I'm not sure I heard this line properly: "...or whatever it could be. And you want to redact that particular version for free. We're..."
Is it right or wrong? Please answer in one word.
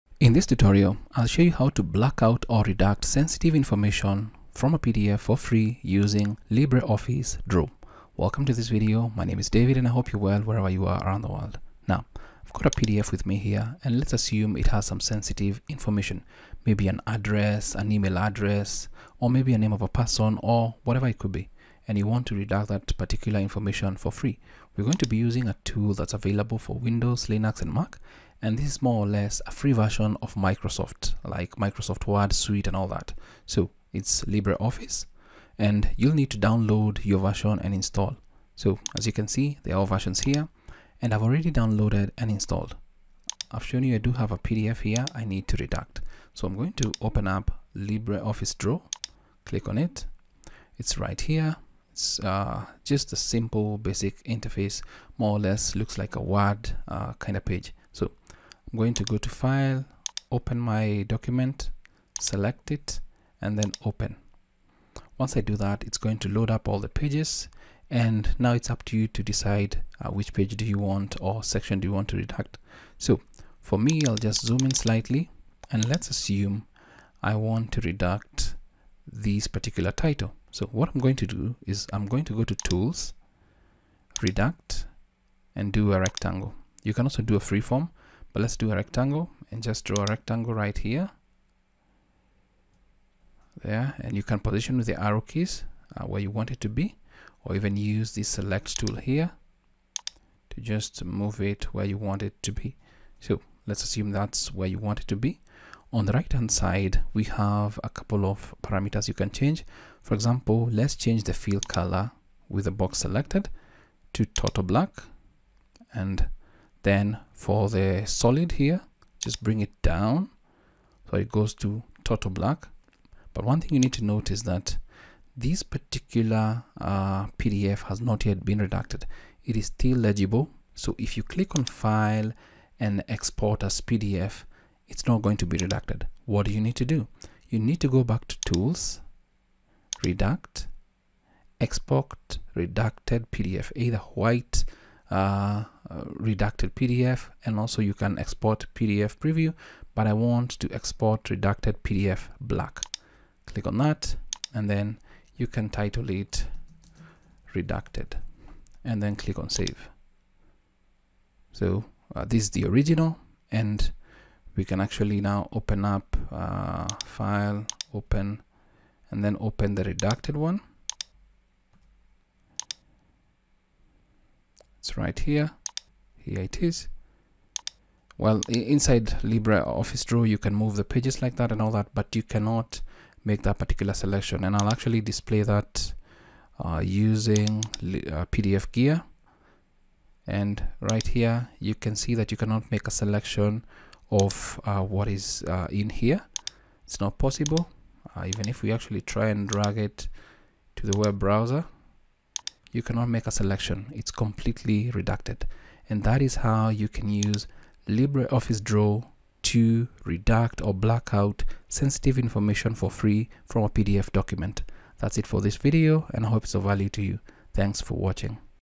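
wrong.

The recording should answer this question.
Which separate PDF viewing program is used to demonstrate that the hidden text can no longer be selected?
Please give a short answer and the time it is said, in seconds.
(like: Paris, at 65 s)
PDFgear, at 188 s.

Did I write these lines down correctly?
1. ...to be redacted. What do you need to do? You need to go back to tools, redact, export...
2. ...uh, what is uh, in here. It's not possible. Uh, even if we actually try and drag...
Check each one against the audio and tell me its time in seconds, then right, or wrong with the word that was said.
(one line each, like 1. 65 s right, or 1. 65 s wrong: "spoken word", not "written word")
1. 135 s right
2. 194 s right.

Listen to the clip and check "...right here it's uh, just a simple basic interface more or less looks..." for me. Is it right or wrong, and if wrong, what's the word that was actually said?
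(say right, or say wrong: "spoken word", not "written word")
right.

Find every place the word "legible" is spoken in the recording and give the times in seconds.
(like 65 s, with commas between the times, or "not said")
129 s.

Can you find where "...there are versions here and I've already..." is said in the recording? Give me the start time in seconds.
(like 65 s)
39 s.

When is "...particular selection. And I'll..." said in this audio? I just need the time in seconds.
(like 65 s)
183 s.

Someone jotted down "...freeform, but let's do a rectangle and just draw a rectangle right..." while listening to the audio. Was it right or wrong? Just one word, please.
right.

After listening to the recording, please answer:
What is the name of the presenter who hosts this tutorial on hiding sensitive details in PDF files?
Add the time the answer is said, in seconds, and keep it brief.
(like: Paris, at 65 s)
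David, at 9 s.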